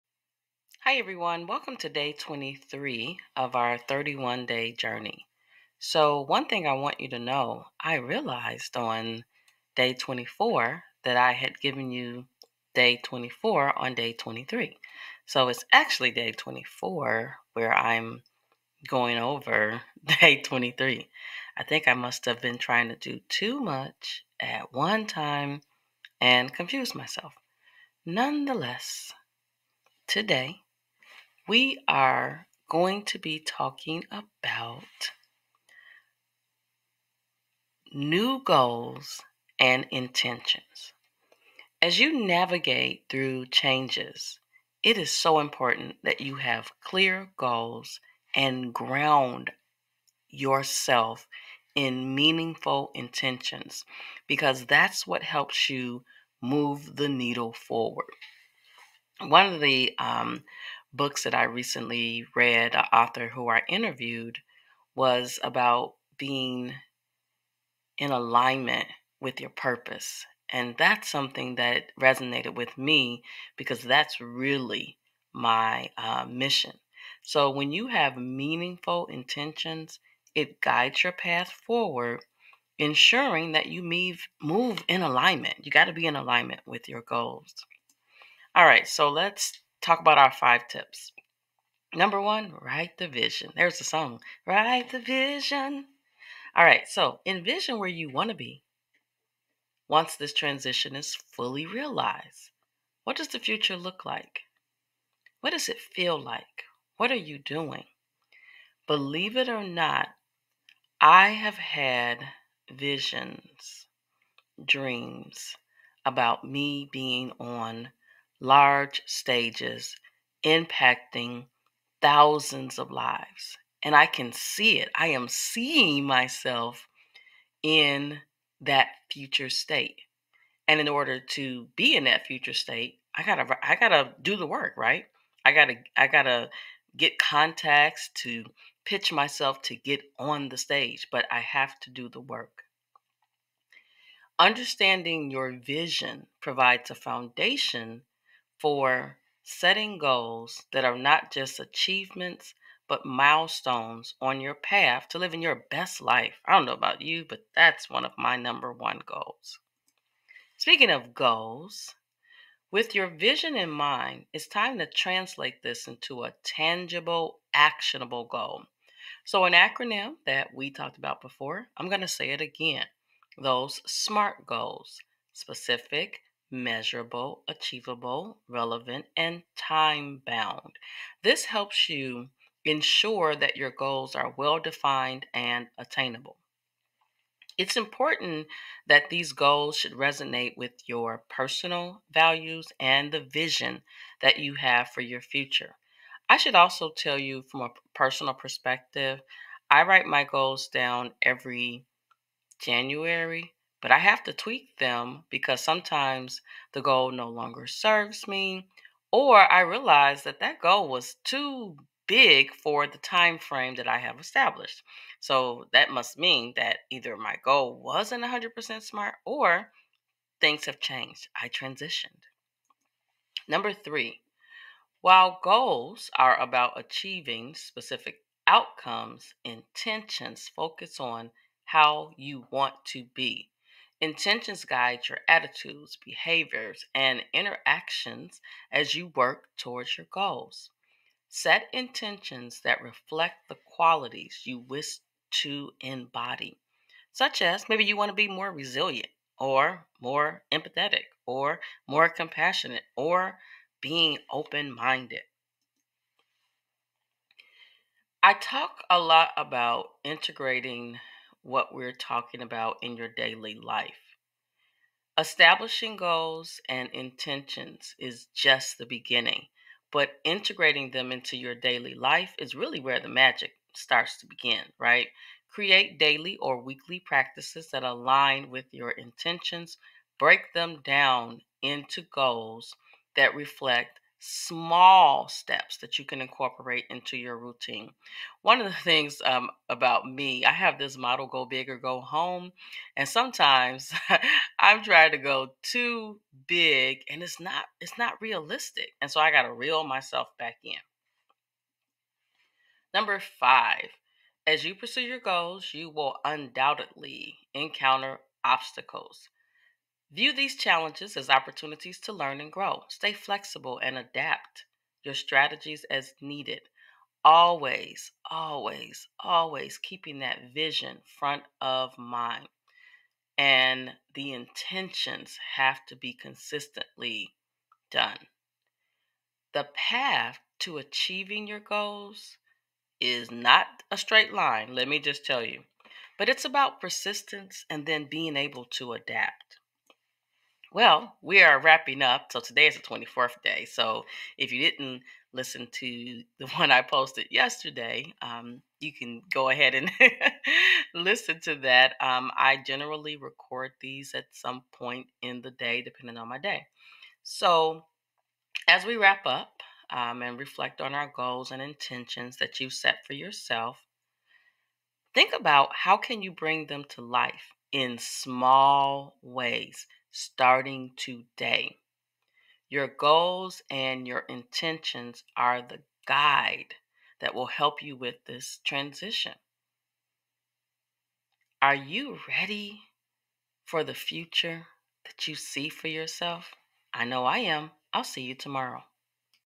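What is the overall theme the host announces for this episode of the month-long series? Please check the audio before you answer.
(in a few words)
New goals and intentions.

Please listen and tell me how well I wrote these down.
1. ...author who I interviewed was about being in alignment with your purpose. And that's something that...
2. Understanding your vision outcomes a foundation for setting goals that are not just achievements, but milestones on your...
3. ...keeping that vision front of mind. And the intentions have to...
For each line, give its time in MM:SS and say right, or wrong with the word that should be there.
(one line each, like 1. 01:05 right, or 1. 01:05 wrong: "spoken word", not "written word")
1. 01:02 right
2. 02:24 wrong: "provides", not "outcomes"
3. 05:19 right.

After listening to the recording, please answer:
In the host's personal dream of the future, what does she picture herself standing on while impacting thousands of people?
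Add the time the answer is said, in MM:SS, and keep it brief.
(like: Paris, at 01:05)
Large stages, at 01:58.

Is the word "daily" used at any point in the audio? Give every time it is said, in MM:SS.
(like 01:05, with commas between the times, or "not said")
04:23, 04:31, 04:35.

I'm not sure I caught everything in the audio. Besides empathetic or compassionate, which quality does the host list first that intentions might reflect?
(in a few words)
Resilient.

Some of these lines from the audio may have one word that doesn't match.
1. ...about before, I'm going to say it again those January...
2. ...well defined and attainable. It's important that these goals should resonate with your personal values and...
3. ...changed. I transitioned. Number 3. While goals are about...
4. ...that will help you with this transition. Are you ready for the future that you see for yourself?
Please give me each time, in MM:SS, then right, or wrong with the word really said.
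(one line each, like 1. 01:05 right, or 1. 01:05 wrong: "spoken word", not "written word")
1. 02:50 wrong: "SMART", not "January"
2. 03:04 right
3. 03:40 right
4. 06:17 right.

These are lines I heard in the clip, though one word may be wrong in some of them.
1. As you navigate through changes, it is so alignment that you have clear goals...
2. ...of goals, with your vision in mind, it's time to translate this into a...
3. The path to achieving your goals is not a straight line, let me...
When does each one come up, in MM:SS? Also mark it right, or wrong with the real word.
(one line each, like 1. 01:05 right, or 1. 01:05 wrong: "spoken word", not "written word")
1. 00:41 wrong: "important", not "alignment"
2. 02:40 right
3. 05:29 right.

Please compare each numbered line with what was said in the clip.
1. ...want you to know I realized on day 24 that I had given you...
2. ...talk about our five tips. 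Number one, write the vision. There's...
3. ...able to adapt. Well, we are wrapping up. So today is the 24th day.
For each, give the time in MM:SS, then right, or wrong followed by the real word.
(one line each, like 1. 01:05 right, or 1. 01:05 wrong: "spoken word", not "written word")
1. 00:06 right
2. 01:29 right
3. 05:38 right.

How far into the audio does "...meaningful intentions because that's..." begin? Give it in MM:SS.
00:52.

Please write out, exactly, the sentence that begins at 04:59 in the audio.
And so I gotta reel myself back in.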